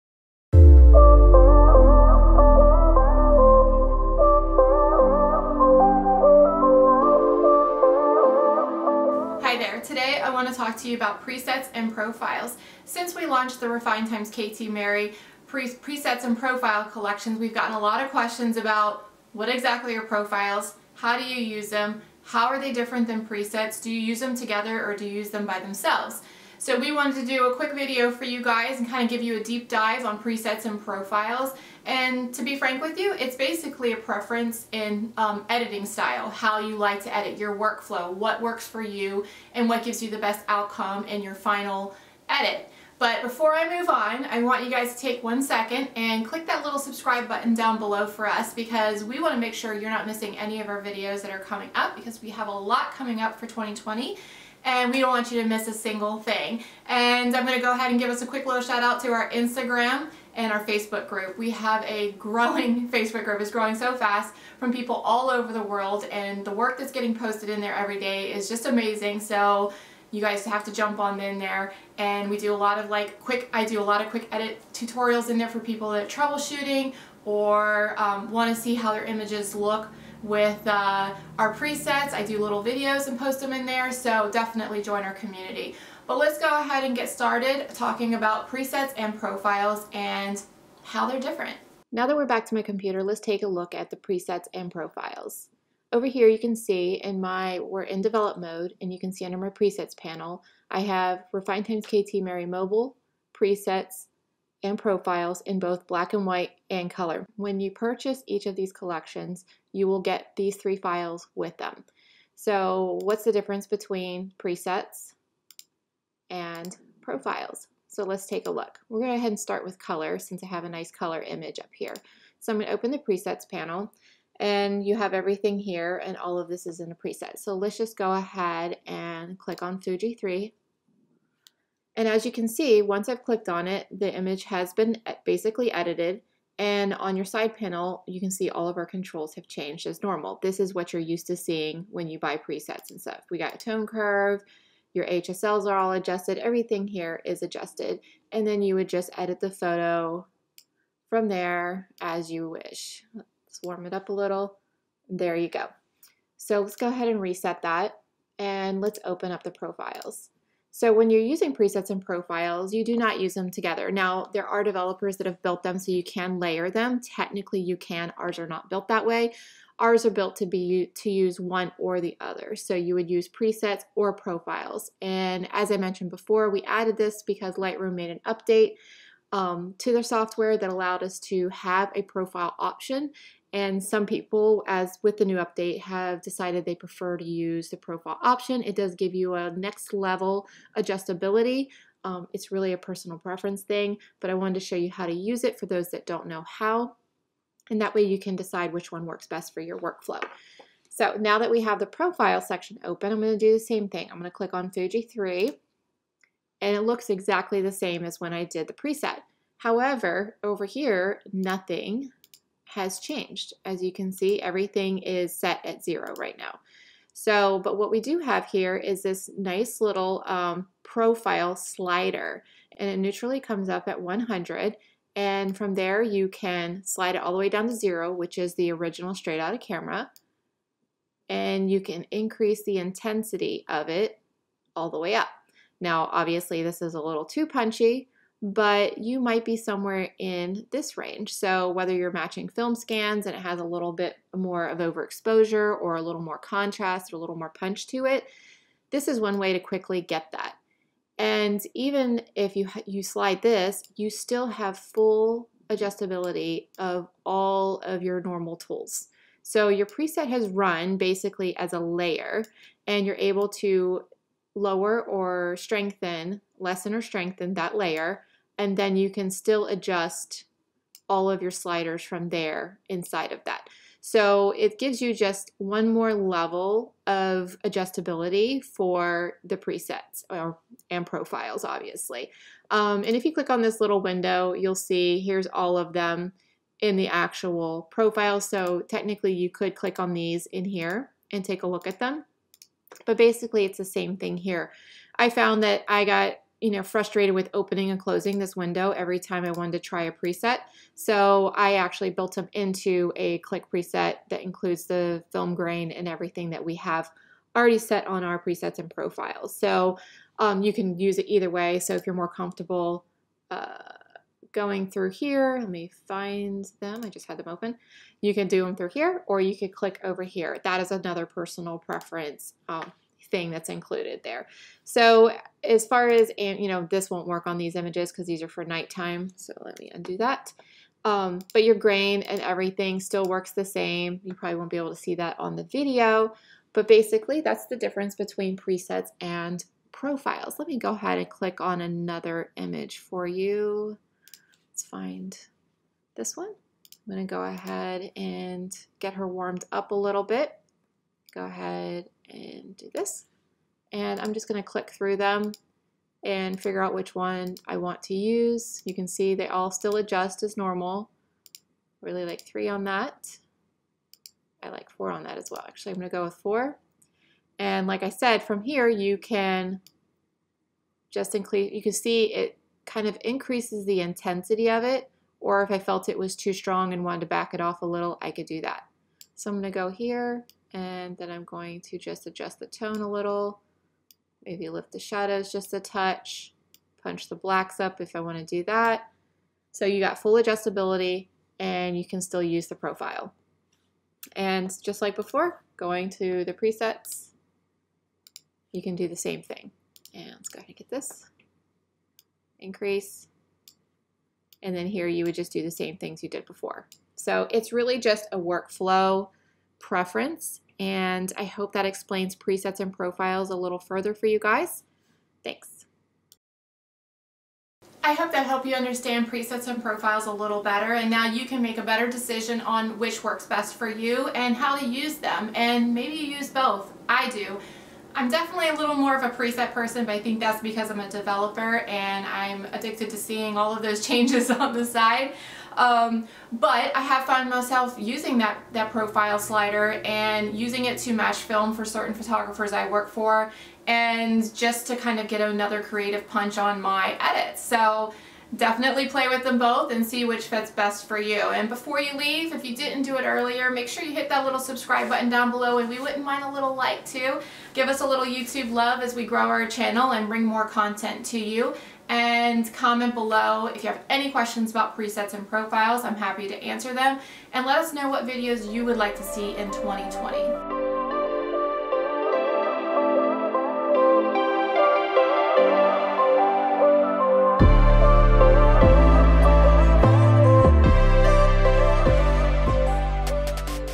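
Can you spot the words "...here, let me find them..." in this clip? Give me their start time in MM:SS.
05:15.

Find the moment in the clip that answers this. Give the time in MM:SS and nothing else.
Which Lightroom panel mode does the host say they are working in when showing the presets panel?
01:38.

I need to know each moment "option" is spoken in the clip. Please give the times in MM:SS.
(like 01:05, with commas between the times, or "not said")
03:02, 03:08.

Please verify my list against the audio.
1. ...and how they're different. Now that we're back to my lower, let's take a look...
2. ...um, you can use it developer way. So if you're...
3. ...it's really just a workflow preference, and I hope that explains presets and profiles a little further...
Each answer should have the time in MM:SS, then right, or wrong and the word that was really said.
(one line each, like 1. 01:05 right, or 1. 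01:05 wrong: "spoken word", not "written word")
1. 01:29 wrong: "computer", not "lower"
2. 05:10 wrong: "either", not "developer"
3. 06:47 right.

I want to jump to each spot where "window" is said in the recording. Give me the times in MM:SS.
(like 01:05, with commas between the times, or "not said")
04:44, 04:58.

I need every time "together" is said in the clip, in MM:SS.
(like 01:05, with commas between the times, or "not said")
00:24, 02:43.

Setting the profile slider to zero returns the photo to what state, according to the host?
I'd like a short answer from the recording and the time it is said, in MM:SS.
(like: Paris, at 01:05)
original straight out of camera, at 03:48.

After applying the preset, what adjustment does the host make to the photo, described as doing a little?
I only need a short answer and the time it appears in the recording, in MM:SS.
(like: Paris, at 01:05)
warm it up, at 02:33.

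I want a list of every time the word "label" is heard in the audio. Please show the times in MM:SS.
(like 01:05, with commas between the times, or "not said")
not said.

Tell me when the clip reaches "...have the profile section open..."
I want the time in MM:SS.
03:21.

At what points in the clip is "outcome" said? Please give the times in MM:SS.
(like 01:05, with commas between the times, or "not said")
00:40.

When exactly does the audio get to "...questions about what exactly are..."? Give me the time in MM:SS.
00:18.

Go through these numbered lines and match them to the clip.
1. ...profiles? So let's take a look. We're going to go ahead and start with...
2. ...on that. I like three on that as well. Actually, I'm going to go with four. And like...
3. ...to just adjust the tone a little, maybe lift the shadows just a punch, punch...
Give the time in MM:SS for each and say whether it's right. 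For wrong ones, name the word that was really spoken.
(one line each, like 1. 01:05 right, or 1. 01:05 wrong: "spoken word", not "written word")
1. 01:57 right
2. 06:02 wrong: "four", not "three"
3. 06:21 wrong: "touch", not "punch".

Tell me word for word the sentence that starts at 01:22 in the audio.
I do little videos and post them in there, so definitely join our community.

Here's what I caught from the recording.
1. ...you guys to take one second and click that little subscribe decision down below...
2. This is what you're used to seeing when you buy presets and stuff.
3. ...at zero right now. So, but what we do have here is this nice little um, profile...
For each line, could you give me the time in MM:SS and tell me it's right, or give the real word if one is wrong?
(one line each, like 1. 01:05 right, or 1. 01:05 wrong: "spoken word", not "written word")
1. 00:44 wrong: "button", not "decision"
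2. 02:20 right
3. 03:35 right.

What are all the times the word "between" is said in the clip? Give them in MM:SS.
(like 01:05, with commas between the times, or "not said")
01:53, 05:38.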